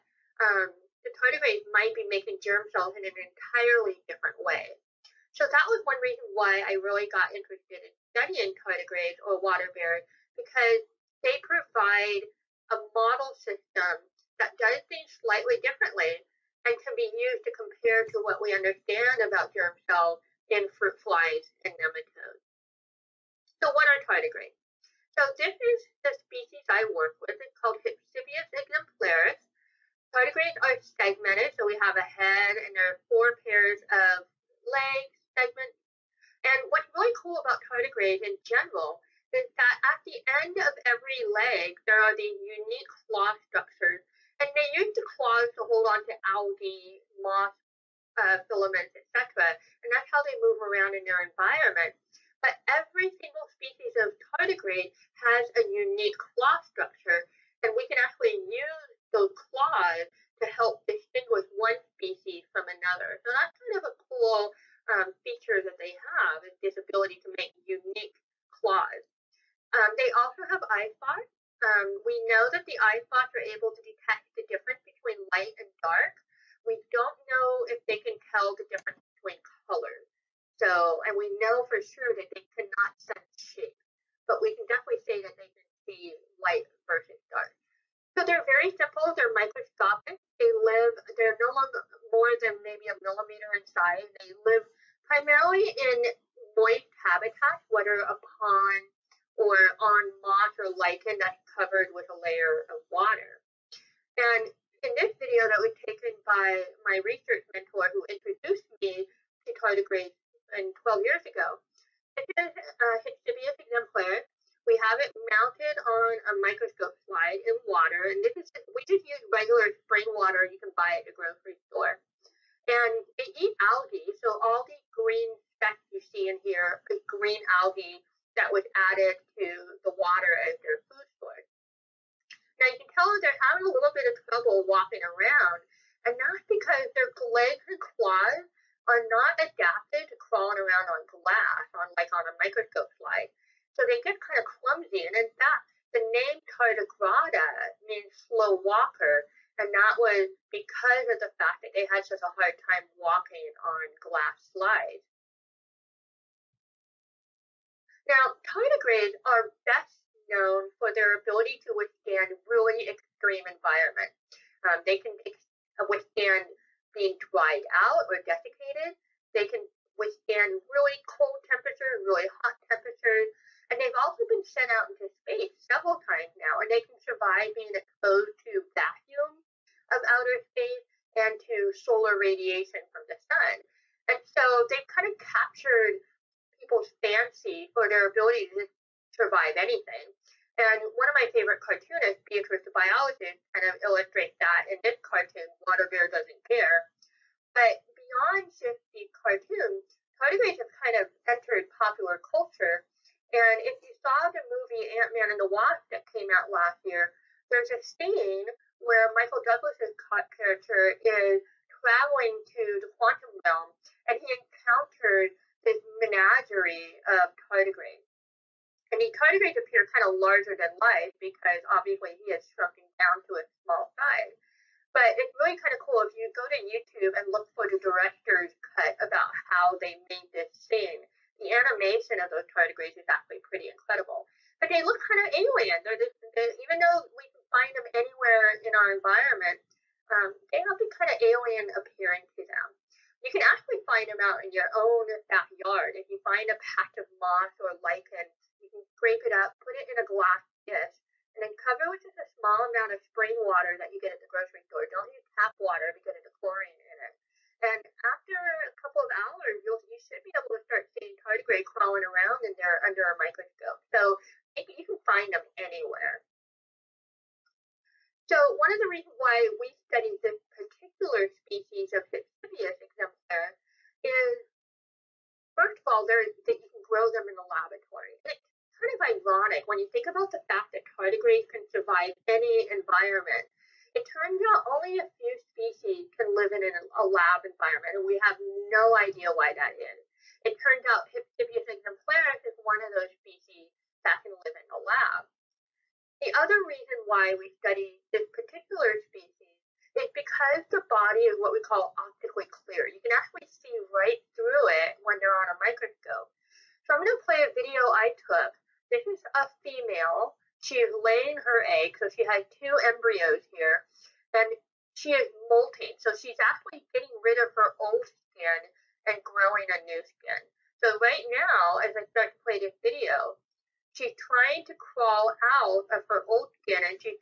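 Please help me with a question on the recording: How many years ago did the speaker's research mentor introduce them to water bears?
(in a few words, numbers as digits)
12.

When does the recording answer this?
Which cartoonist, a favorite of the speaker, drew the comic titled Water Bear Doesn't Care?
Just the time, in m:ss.
3:12.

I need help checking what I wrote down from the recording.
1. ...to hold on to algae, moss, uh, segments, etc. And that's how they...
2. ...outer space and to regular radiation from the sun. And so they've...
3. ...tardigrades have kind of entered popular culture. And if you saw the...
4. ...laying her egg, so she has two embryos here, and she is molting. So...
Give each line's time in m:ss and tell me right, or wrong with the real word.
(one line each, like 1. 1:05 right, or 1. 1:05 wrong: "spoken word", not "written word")
1. 0:45 wrong: "filaments", not "segments"
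2. 3:00 wrong: "solar", not "regular"
3. 3:20 right
4. 5:11 right.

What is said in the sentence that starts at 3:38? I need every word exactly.
And he kind of appeared kind of larger than life because obviously he has shrunken down to a small size.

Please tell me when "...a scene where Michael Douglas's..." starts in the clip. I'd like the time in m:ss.
3:27.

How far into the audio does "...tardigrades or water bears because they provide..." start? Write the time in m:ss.
0:08.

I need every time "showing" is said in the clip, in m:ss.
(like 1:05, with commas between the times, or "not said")
not said.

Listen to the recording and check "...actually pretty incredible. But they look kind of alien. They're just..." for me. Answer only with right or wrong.
right.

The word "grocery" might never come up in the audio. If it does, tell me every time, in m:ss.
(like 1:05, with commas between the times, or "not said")
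2:01, 4:14.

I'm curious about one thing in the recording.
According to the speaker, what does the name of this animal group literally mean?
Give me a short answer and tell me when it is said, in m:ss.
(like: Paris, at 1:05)
slow walker, at 2:28.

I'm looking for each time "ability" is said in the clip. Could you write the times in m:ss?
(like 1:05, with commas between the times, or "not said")
2:41, 3:08.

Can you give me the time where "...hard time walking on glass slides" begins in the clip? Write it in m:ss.
2:32.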